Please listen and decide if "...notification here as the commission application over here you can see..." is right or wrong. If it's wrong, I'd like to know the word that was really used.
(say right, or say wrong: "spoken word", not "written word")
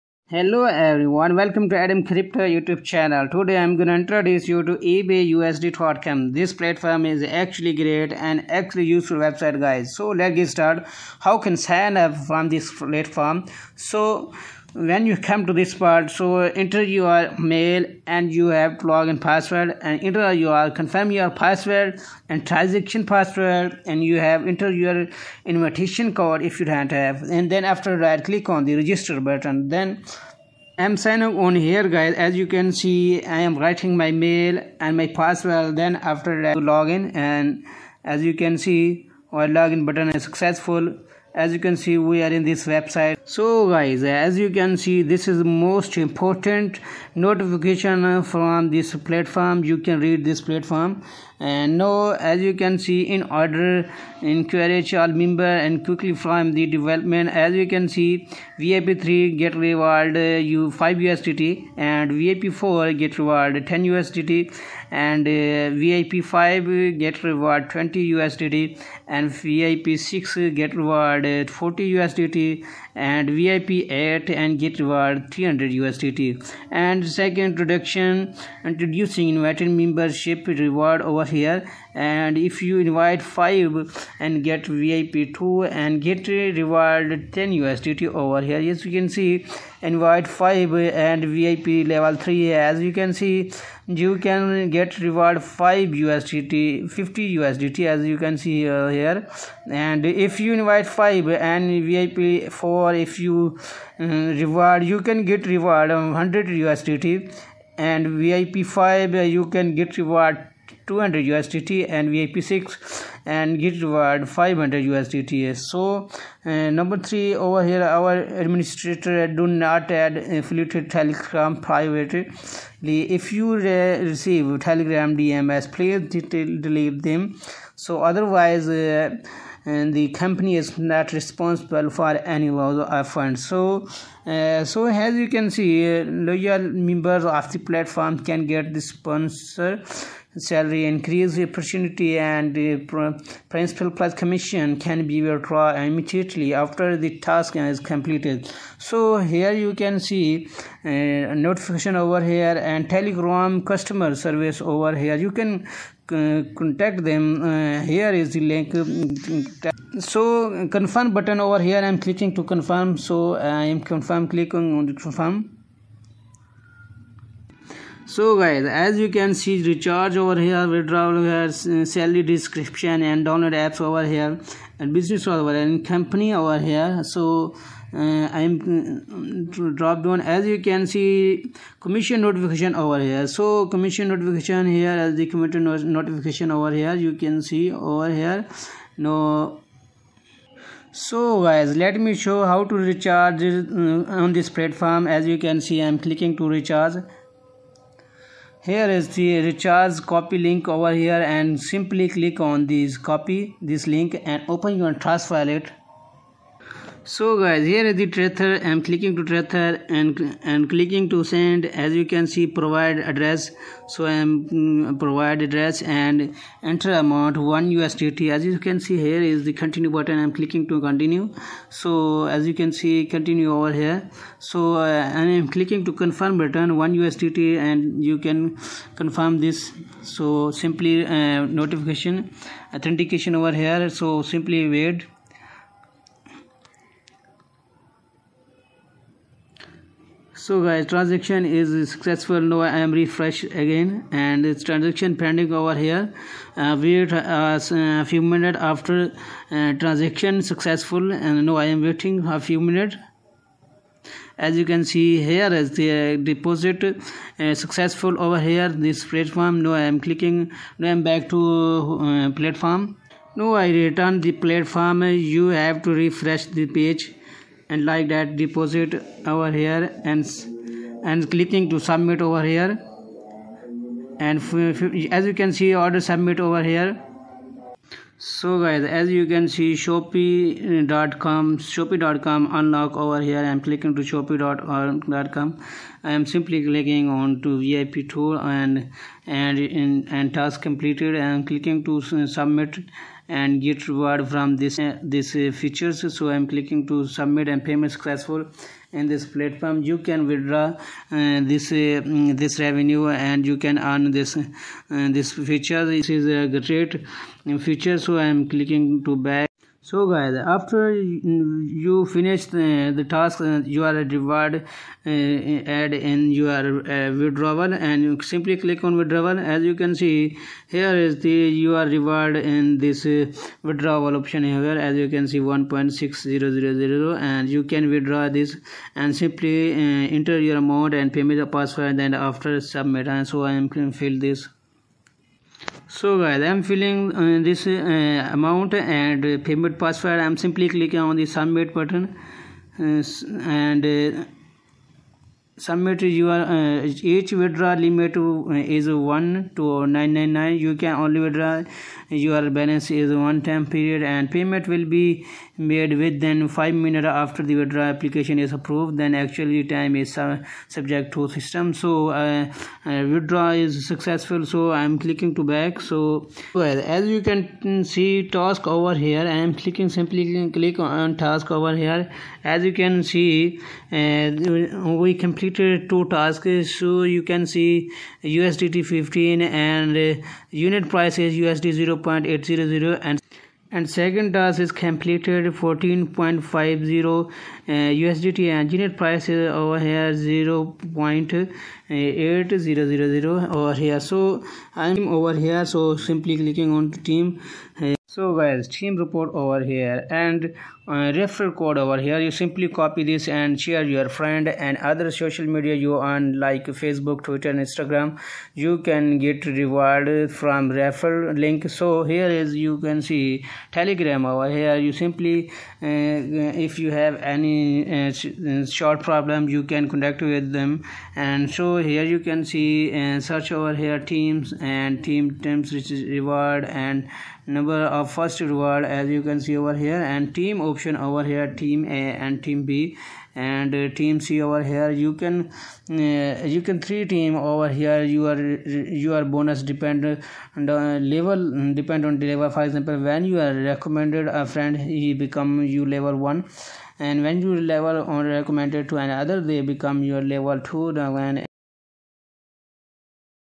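wrong: "notification", not "application".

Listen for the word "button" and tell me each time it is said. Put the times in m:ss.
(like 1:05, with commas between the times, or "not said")
0:29, 0:39, 2:41, 3:39, 5:41.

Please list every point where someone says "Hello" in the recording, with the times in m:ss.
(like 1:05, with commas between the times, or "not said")
0:00.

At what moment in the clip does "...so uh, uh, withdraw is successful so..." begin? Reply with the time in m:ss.
6:01.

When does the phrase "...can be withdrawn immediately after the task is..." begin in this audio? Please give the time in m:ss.
2:24.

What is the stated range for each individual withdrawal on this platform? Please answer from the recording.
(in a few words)
1 to 999.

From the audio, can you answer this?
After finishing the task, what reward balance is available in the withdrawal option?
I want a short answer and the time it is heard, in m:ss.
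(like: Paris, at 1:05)
1.6000, at 5:25.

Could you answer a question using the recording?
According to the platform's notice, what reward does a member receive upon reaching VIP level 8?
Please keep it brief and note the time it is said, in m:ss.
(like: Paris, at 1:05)
300 USDT, at 1:15.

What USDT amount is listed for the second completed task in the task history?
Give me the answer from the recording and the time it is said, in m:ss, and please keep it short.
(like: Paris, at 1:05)
14.50 USDT, at 6:25.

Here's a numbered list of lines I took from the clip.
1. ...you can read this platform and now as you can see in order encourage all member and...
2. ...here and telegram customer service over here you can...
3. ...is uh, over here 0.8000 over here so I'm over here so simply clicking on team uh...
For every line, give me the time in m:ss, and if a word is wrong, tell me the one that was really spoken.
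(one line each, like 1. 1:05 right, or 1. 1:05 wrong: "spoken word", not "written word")
1. 0:49 right
2. 2:32 right
3. 6:29 right.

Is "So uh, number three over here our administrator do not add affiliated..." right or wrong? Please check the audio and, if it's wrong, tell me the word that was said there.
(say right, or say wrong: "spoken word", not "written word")
right.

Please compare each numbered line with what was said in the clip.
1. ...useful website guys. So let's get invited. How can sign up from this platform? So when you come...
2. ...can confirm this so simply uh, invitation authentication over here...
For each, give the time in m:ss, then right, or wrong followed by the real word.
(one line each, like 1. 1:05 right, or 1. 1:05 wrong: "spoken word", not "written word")
1. 0:08 wrong: "started", not "invited"
2. 3:48 wrong: "notification", not "invitation".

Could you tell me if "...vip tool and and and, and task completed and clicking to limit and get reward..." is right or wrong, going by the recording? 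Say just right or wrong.
wrong.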